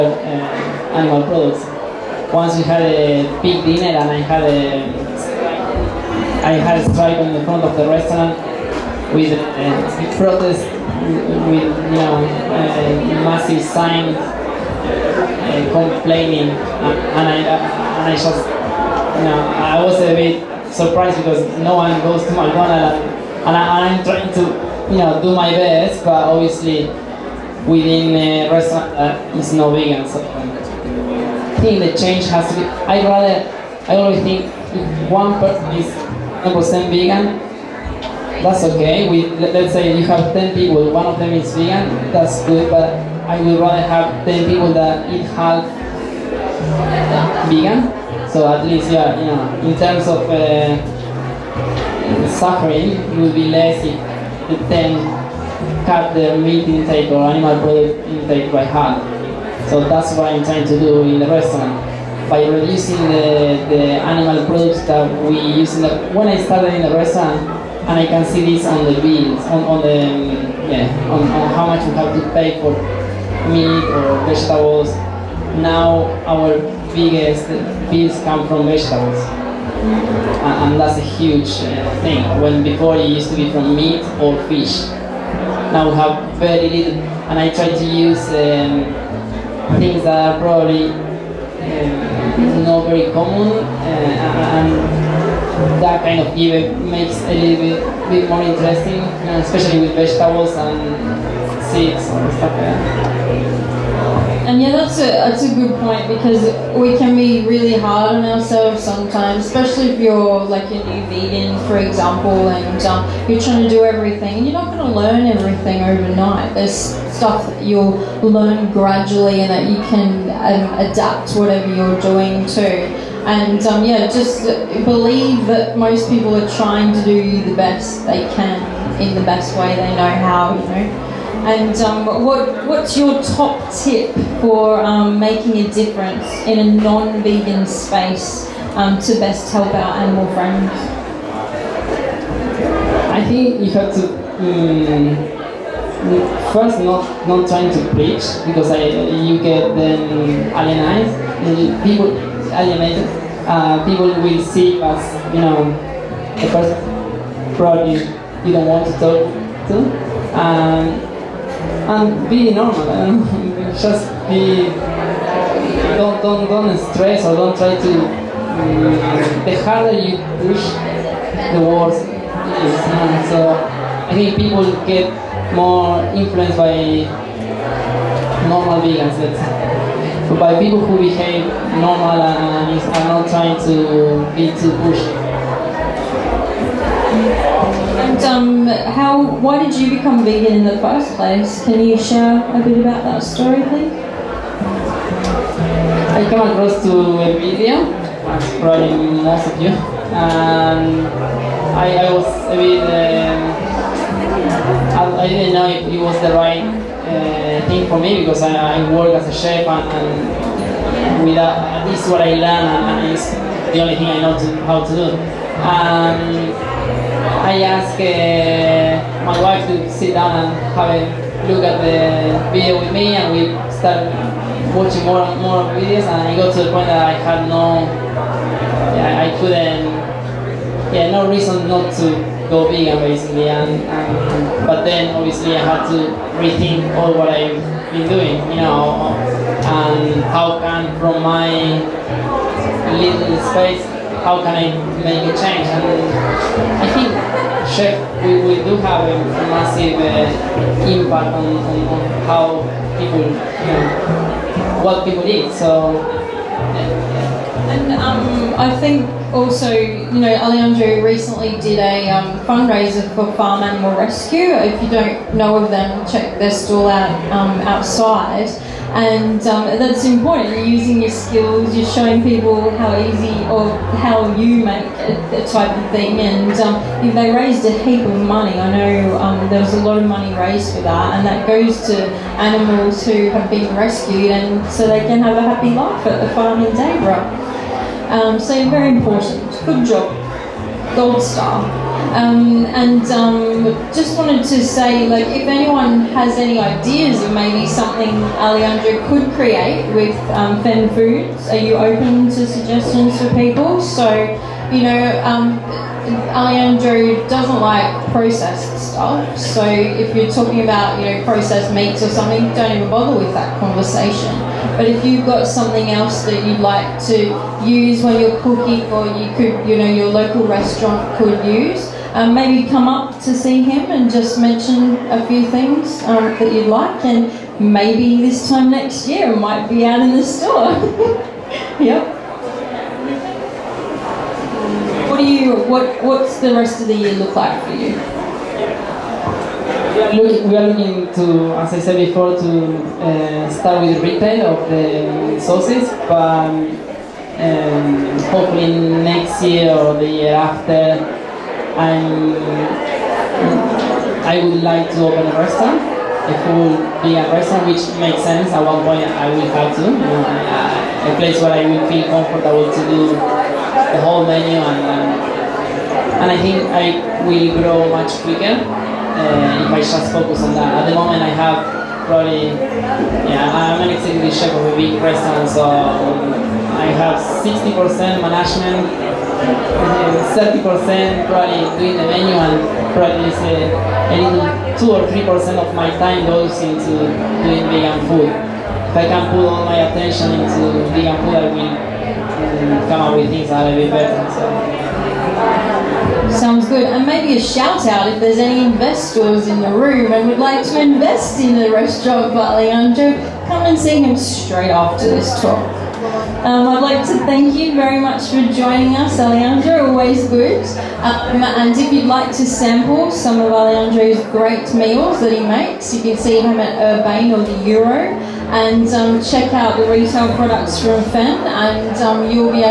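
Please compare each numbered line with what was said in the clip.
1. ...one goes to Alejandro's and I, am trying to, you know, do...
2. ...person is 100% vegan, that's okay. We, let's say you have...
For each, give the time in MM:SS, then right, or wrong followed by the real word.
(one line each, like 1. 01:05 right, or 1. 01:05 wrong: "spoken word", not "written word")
1. 00:21 wrong: "McDonald", not "Alejandro"
2. 00:35 right.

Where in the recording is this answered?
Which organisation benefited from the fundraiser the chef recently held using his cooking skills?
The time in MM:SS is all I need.
04:23.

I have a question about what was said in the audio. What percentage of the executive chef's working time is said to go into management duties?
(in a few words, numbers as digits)
60%.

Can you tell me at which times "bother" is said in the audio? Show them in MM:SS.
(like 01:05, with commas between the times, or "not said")
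05:12.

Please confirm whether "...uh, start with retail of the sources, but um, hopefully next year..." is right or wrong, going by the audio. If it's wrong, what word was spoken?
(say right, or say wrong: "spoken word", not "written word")
right.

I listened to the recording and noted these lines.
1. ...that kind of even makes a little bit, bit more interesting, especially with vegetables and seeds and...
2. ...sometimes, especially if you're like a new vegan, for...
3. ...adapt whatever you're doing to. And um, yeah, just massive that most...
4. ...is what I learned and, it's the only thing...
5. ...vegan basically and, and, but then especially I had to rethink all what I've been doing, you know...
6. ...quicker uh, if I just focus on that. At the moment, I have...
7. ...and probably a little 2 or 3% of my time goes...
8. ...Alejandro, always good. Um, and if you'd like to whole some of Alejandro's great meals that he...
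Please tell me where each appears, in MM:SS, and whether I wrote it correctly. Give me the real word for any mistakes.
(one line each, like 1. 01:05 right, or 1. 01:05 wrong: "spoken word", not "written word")
1. 01:35 right
2. 01:48 right
3. 02:00 wrong: "believe", not "massive"
4. 03:32 right
5. 03:52 wrong: "obviously", not "especially"
6. 06:08 right
7. 06:22 right
8. 06:49 wrong: "sample", not "whole".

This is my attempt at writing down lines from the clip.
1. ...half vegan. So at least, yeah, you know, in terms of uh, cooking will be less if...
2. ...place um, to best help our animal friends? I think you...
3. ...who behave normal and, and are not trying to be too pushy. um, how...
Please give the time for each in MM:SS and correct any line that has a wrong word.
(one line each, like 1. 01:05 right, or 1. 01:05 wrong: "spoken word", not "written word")
1. 00:45 wrong: "suffering", not "cooking"
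2. 02:17 wrong: "space", not "place"
3. 03:00 right.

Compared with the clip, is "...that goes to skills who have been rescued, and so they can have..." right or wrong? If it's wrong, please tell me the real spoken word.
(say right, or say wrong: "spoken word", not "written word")
wrong: "animals", not "skills".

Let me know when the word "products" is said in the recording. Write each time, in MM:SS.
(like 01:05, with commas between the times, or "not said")
00:01, 00:57, 01:04, 02:37, 07:00.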